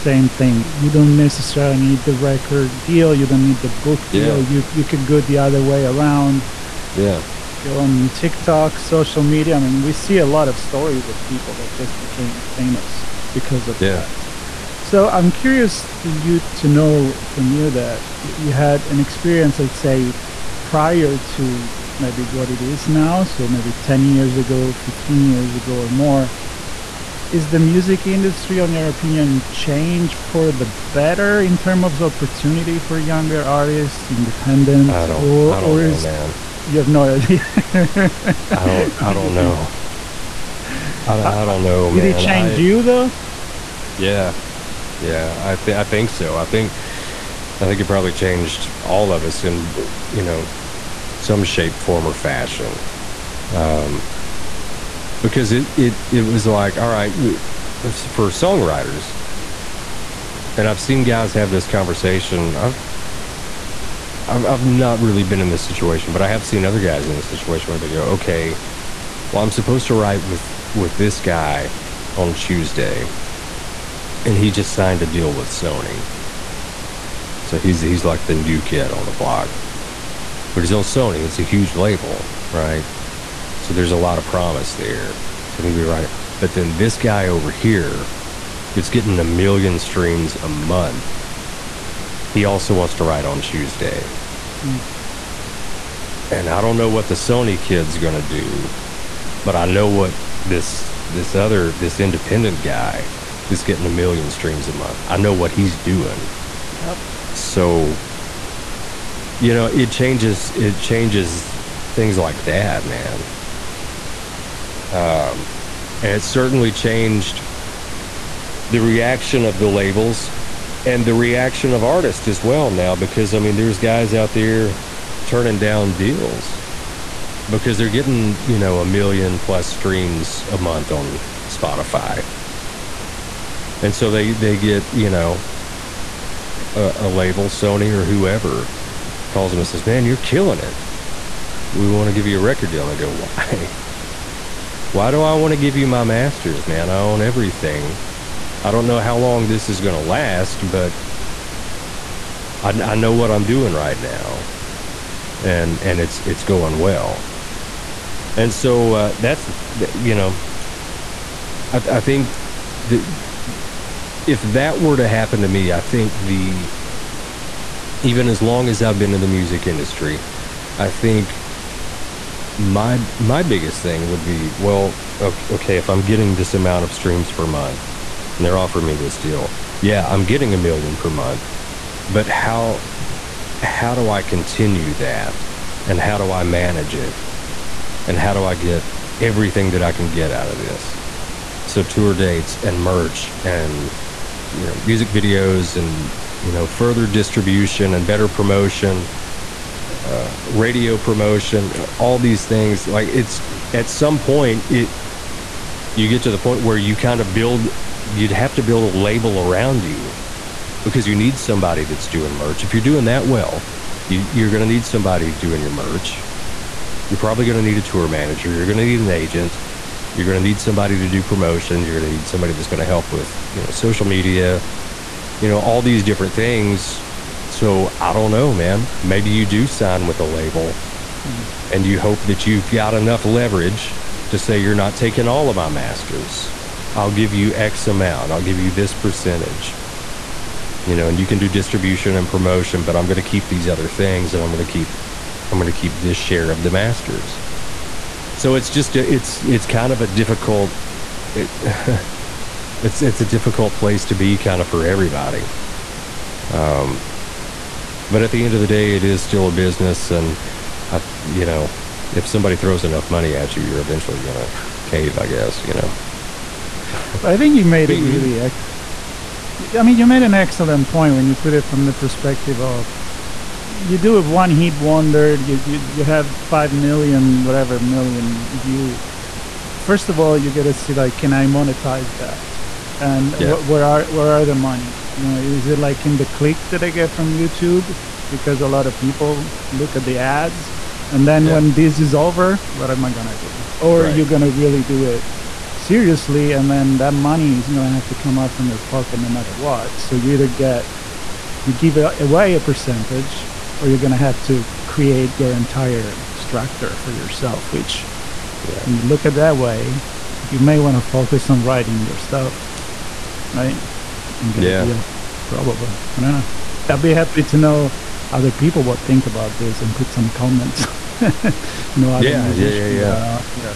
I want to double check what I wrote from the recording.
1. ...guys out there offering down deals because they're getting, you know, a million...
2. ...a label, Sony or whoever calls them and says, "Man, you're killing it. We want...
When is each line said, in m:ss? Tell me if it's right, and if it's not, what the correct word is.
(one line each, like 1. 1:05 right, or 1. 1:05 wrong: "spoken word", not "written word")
1. 2:03 wrong: "turning", not "offering"
2. 2:16 right.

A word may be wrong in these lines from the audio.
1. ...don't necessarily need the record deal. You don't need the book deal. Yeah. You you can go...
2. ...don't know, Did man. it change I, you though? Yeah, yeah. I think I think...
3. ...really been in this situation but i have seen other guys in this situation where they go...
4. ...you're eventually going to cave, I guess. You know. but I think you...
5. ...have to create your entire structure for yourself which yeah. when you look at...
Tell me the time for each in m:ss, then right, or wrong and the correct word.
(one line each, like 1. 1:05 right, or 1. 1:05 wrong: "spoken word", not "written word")
1. 0:00 right
2. 0:41 right
3. 1:04 right
4. 4:23 right
5. 5:04 right.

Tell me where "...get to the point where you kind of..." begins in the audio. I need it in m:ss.
3:26.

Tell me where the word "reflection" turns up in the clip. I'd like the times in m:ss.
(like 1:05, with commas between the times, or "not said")
not said.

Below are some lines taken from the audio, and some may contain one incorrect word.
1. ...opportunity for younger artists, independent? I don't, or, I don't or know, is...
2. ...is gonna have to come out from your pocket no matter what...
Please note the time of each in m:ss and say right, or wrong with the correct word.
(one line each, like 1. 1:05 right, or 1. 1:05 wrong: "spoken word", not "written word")
1. 0:32 right
2. 4:57 right.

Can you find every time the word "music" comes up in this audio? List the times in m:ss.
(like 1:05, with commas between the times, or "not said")
0:27, 2:49, 3:14.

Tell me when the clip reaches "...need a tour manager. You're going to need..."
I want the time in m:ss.
3:37.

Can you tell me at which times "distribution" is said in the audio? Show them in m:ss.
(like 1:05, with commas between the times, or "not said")
3:17, 4:01.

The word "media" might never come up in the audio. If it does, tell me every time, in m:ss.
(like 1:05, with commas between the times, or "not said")
0:09, 3:44.